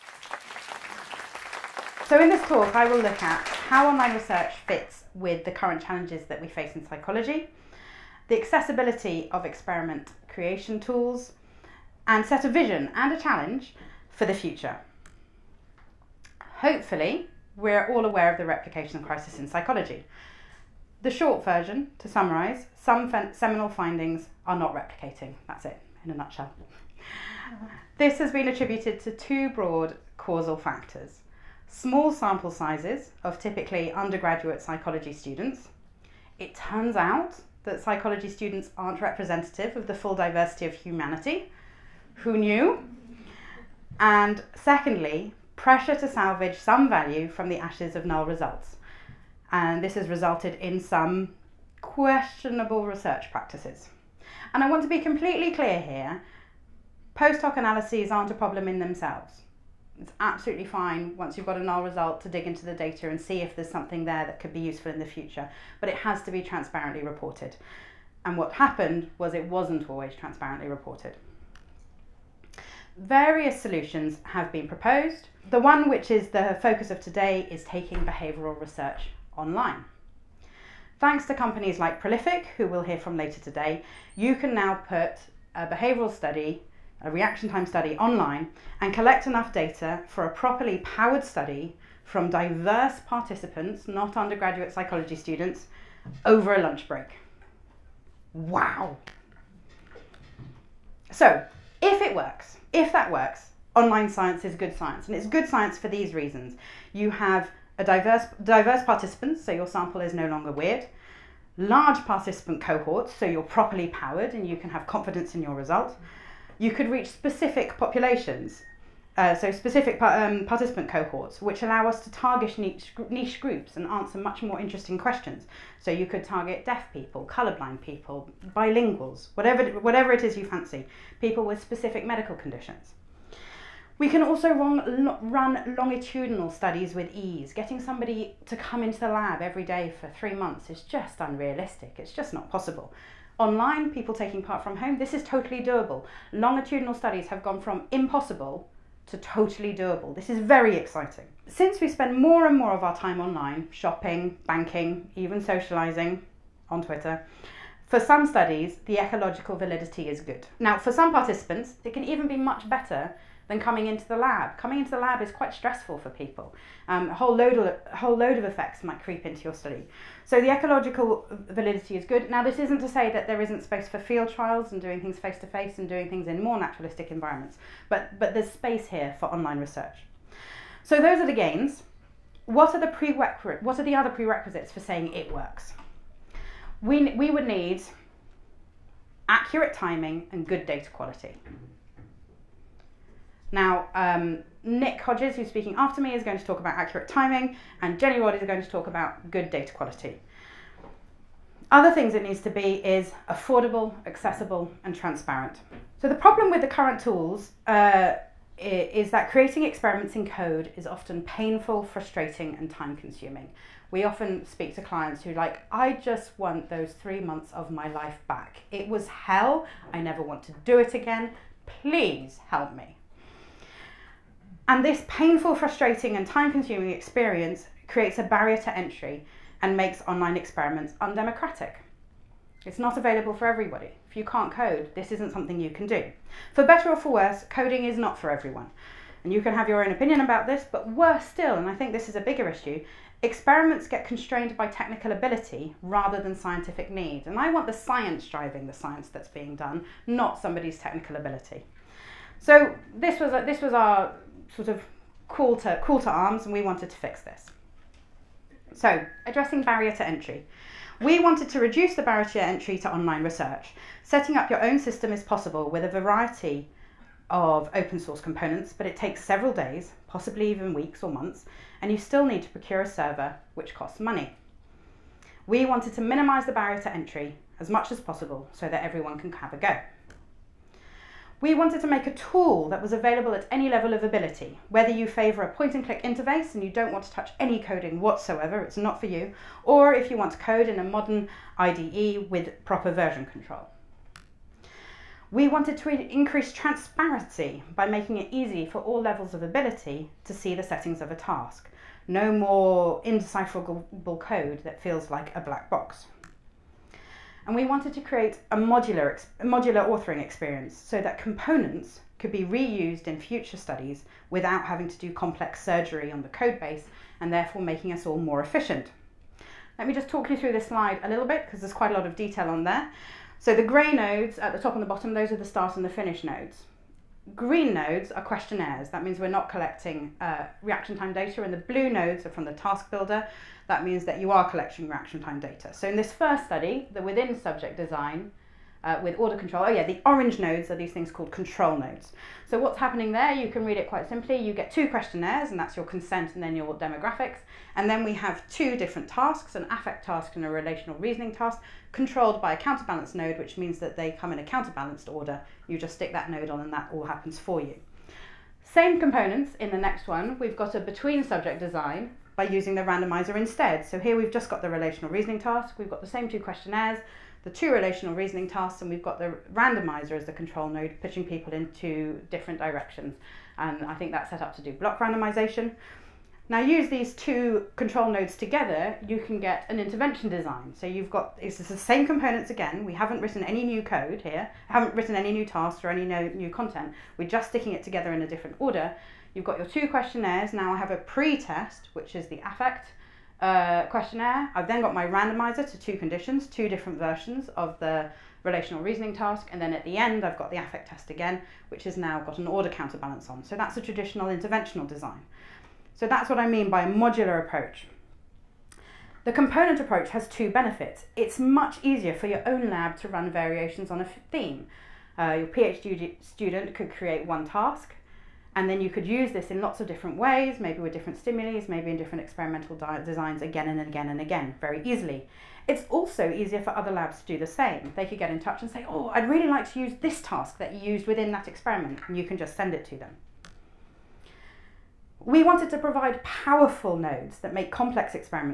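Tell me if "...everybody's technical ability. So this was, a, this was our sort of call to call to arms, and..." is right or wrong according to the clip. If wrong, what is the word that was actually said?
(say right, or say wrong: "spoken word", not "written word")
wrong: "somebody", not "everybody".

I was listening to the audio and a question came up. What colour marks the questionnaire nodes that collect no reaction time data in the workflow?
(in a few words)
Green.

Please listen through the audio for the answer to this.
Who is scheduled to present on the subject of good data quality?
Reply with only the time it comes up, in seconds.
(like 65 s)
197 s.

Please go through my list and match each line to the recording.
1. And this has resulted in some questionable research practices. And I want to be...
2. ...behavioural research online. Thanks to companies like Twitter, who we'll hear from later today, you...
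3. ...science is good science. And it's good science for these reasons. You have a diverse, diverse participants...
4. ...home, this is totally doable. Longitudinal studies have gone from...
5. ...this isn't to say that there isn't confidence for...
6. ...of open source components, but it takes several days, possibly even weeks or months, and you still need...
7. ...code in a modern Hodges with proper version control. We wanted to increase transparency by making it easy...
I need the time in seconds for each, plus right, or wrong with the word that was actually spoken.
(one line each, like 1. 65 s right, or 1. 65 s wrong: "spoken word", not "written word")
1. 49 s right
2. 77 s wrong: "Prolific", not "Twitter"
3. 104 s right
4. 144 s right
5. 172 s wrong: "space", not "confidence"
6. 267 s right
7. 290 s wrong: "IDE", not "Hodges".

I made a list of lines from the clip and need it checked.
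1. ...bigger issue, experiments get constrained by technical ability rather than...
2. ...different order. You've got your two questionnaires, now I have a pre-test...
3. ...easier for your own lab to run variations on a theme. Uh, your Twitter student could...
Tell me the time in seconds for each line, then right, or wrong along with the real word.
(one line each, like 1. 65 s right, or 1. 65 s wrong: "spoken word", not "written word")
1. 242 s right
2. 388 s right
3. 411 s wrong: "PhD", not "Twitter".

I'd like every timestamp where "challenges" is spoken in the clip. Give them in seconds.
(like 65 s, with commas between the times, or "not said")
5 s, 13 s.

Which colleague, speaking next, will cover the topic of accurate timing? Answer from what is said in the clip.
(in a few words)
Nick Hodges.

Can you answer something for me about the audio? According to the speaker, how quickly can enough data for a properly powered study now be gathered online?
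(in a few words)
Over a lunch break.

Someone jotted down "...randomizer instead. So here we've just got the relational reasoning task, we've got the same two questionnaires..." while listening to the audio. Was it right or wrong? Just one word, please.
right.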